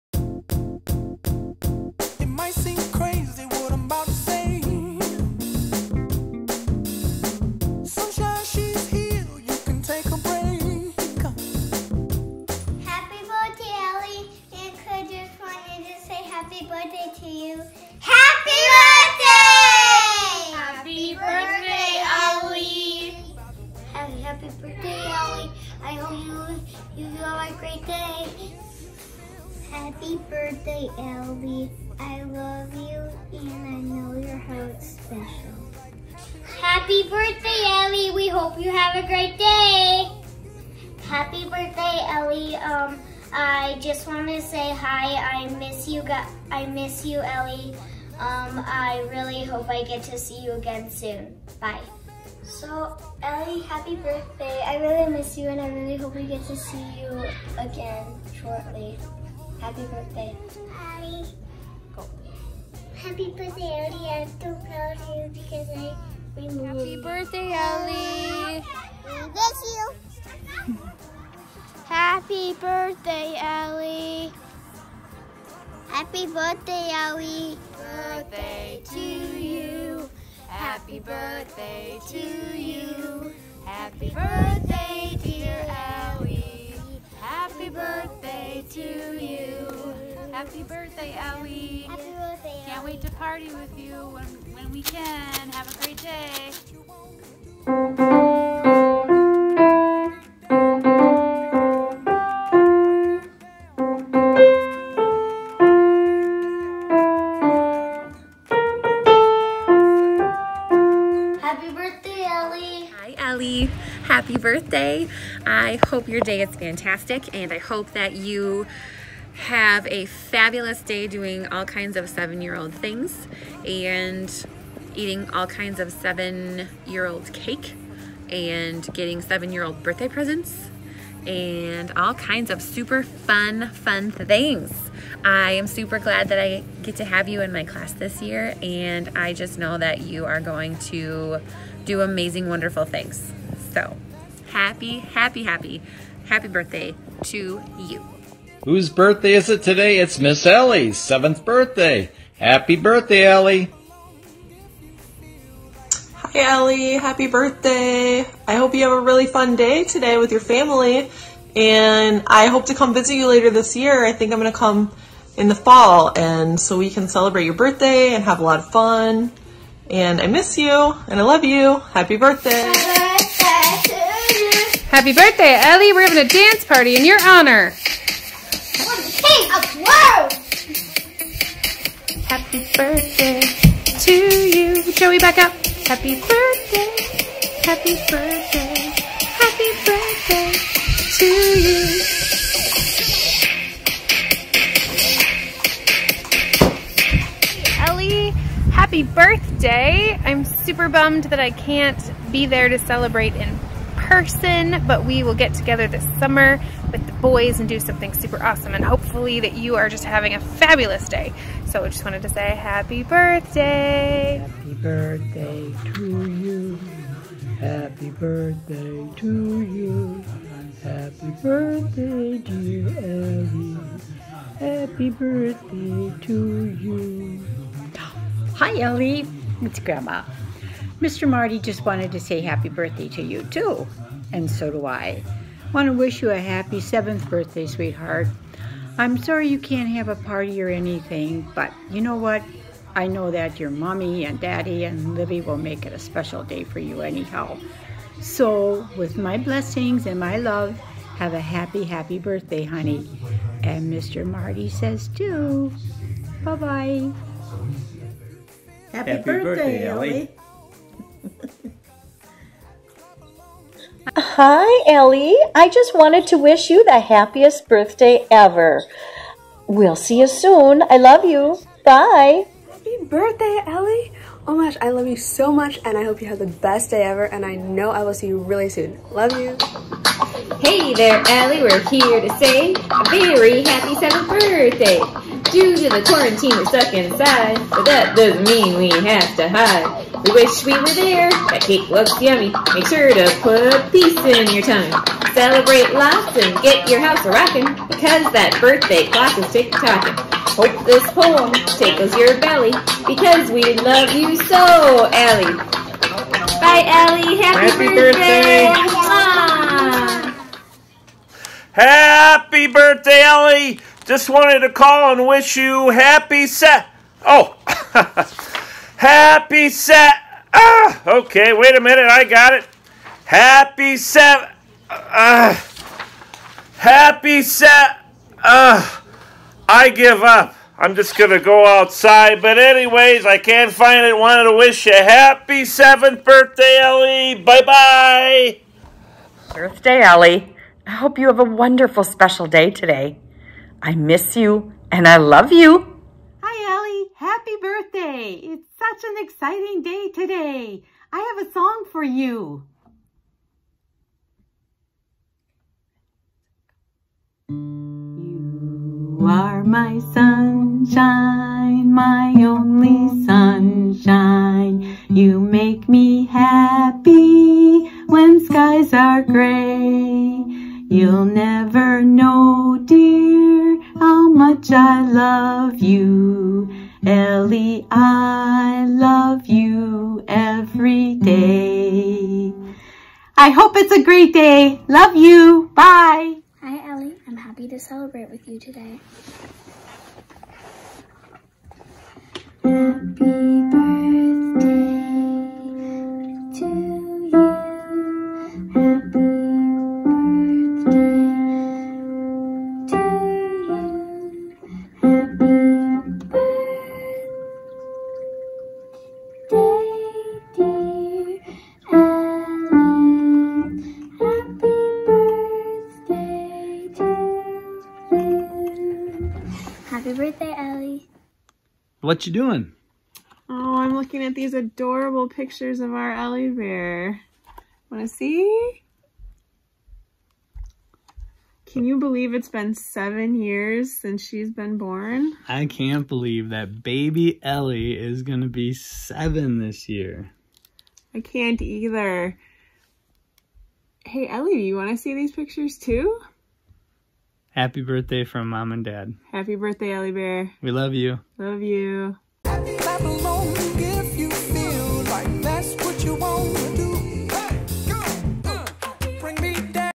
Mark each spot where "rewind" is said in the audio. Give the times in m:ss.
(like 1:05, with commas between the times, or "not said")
not said.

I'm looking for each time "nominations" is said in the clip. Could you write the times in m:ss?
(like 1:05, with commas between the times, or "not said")
not said.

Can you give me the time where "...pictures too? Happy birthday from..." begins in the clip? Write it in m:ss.
7:25.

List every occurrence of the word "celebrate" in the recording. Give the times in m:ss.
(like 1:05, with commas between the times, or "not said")
2:47, 3:22, 4:55, 6:27.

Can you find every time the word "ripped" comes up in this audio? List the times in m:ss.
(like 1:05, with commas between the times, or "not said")
not said.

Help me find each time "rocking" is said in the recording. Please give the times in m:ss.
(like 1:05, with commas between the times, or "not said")
4:57.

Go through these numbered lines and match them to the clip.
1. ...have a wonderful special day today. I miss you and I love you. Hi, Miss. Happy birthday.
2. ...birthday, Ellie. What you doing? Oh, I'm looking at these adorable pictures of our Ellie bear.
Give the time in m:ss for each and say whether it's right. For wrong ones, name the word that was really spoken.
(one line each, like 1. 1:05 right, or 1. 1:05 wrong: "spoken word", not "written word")
1. 5:41 wrong: "Ellie", not "Miss"
2. 7:00 right.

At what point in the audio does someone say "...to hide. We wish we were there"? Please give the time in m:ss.
4:49.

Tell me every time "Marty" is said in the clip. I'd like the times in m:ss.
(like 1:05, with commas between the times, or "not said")
3:51, 4:14.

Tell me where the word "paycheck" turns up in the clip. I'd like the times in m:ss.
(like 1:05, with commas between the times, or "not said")
not said.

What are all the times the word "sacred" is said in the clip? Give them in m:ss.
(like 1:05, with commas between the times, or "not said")
not said.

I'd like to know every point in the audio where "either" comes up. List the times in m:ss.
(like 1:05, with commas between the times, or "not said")
7:21.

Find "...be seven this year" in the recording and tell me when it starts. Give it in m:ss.
7:18.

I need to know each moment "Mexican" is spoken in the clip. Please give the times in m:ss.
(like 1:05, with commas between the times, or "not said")
not said.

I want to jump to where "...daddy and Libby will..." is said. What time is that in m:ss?
4:04.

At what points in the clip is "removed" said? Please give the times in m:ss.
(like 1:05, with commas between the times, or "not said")
1:06.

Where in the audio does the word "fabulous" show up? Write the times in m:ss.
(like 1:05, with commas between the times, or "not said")
2:00, 3:30.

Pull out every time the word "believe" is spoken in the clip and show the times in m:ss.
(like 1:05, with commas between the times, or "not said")
7:11, 7:16.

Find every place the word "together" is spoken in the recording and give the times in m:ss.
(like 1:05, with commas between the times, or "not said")
3:25.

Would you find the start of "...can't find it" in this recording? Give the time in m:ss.
5:33.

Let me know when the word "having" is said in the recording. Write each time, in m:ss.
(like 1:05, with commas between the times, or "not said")
2:56, 3:30.